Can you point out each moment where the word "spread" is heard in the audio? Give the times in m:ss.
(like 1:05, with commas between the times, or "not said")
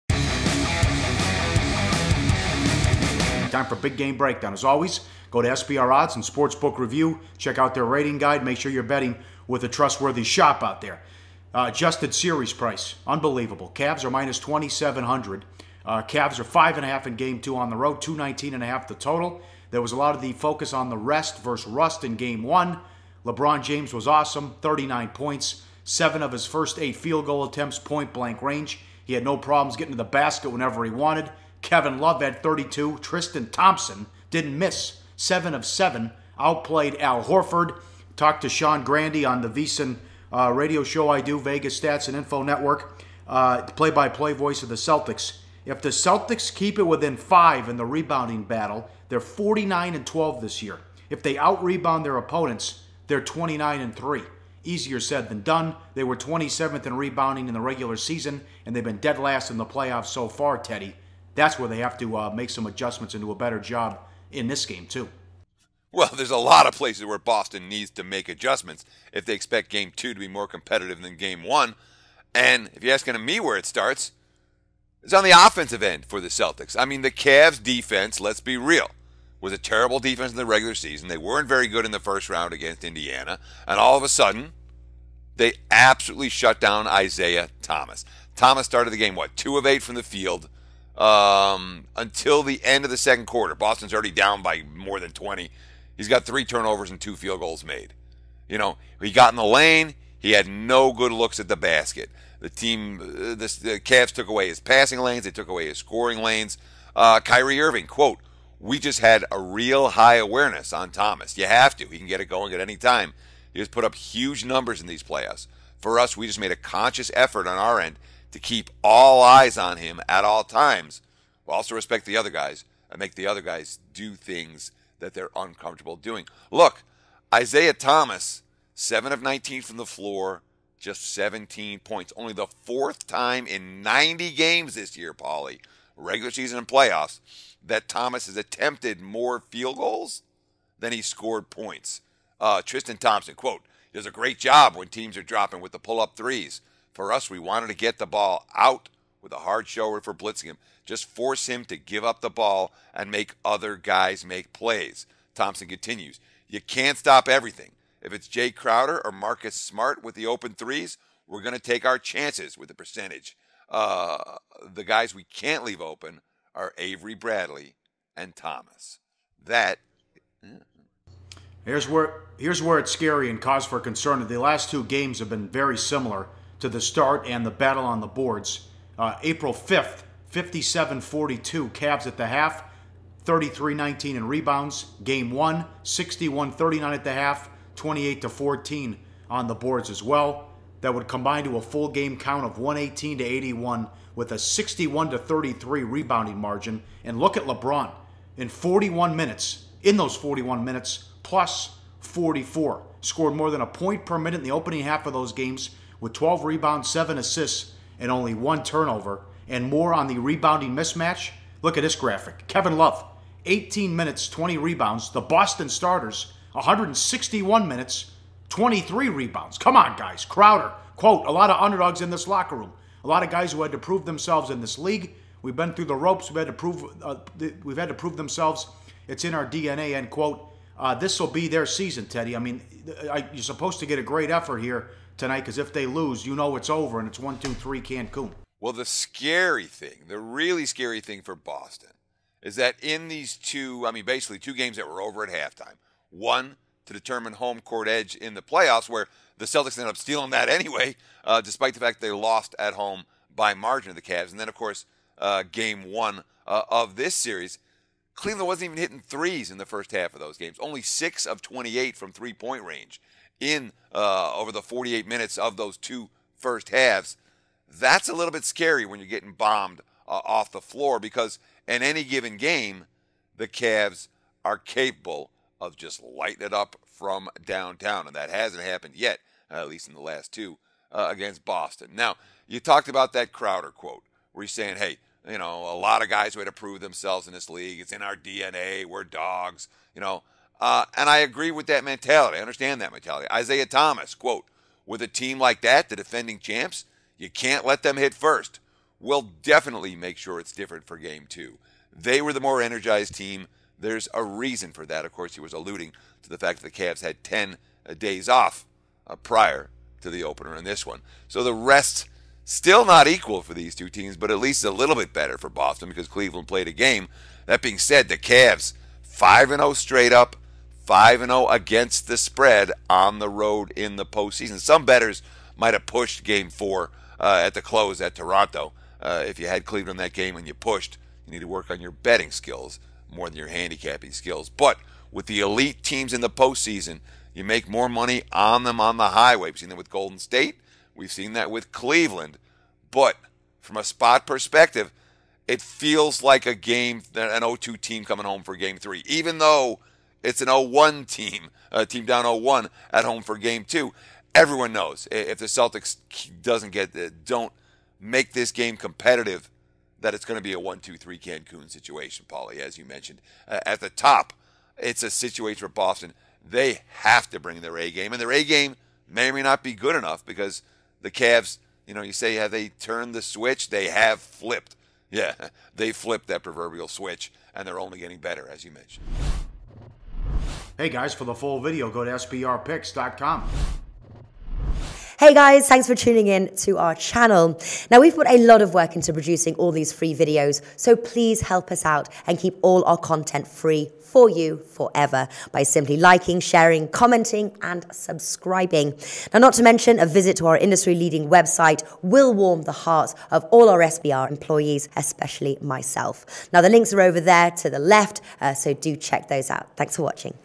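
5:22.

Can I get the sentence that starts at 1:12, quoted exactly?
And if you're asking me where it starts, it's on the offensive end for the Celtics.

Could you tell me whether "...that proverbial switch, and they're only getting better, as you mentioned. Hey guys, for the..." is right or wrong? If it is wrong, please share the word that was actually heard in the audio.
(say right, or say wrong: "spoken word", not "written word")
right.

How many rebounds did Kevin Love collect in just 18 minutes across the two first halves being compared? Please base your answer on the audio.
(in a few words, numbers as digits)
20.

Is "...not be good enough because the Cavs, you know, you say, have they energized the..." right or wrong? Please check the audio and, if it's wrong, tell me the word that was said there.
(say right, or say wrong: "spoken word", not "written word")
wrong: "turned", not "energized".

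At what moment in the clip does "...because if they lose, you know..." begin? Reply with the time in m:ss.
3:55.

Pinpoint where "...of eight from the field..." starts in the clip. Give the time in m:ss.
1:29.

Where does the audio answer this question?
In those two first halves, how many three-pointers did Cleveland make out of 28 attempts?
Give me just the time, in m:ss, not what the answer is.
4:20.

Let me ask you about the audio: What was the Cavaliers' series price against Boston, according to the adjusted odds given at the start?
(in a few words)
-2700.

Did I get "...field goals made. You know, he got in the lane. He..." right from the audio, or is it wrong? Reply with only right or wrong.
right.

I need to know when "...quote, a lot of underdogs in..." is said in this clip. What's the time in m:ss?
3:40.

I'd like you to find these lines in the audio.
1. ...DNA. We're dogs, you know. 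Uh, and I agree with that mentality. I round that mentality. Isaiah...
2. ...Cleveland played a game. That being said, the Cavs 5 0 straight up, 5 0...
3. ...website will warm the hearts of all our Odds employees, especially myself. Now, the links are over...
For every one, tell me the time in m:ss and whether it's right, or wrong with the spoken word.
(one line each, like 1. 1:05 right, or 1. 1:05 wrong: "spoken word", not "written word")
1. 4:48 wrong: "understand", not "round"
2. 5:16 right
3. 6:41 wrong: "SBR", not "Odds".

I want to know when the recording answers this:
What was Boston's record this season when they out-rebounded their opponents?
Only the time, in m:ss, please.
0:53.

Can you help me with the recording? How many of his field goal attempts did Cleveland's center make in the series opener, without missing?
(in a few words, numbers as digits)
7 of 7.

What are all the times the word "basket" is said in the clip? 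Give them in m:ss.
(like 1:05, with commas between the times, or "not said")
0:30, 1:41.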